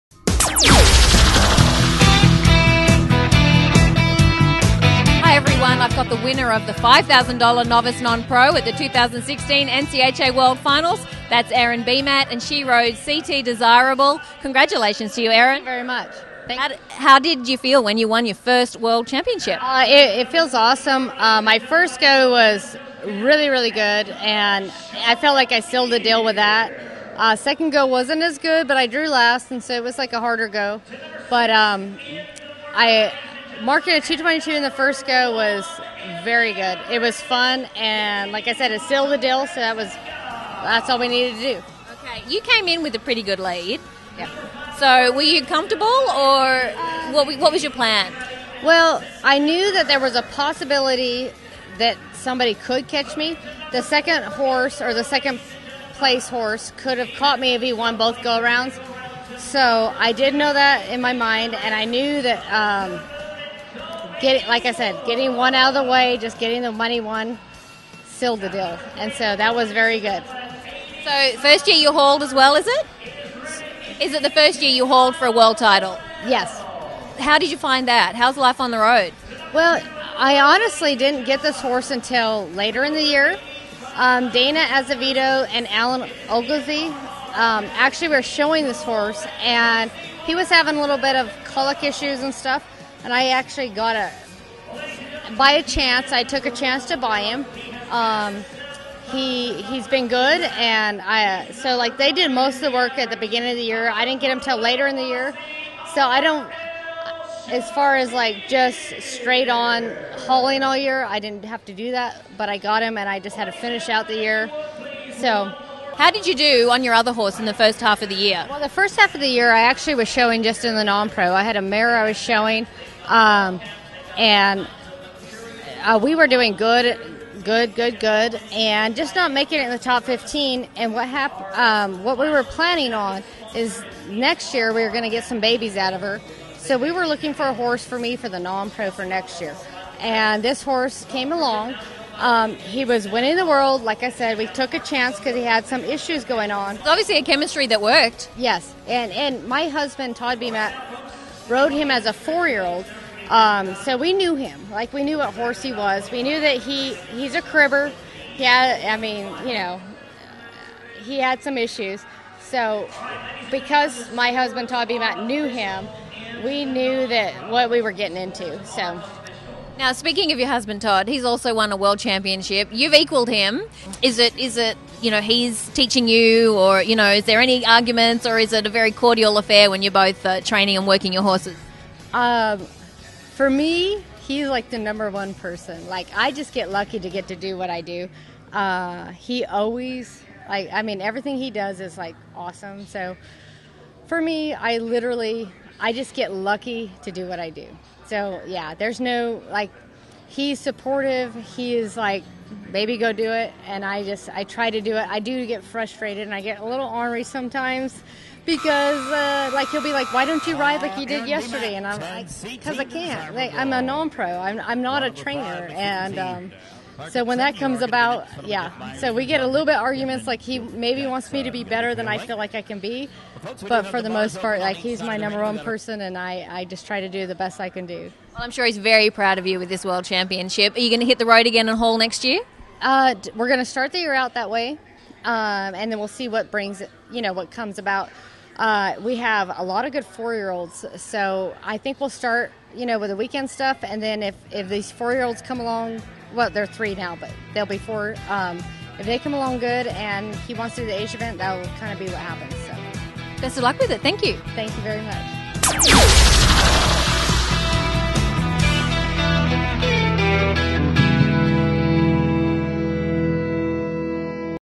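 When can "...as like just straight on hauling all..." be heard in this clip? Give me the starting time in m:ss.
1:47.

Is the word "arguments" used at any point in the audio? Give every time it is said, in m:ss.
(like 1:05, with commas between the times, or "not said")
2:57, 3:39.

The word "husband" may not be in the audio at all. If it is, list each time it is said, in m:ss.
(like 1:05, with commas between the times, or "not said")
2:29, 2:44, 2:50.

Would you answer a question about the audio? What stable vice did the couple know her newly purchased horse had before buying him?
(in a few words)
cribber.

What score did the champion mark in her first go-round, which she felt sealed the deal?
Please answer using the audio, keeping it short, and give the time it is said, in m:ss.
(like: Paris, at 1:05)
222, at 0:34.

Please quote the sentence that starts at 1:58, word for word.
Well, the first half of the year, I actually was showing just in the non pro.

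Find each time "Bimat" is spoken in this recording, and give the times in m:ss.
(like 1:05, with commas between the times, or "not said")
0:11, 2:30.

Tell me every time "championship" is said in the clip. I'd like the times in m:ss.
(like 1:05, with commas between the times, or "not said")
0:19, 2:51, 3:50.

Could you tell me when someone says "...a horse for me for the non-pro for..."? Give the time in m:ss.
2:17.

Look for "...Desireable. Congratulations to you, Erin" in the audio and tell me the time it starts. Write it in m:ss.
0:13.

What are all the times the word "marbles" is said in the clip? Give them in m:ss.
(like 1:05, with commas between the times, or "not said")
not said.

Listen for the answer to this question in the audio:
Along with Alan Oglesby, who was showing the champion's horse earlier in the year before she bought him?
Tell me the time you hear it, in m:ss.
1:24.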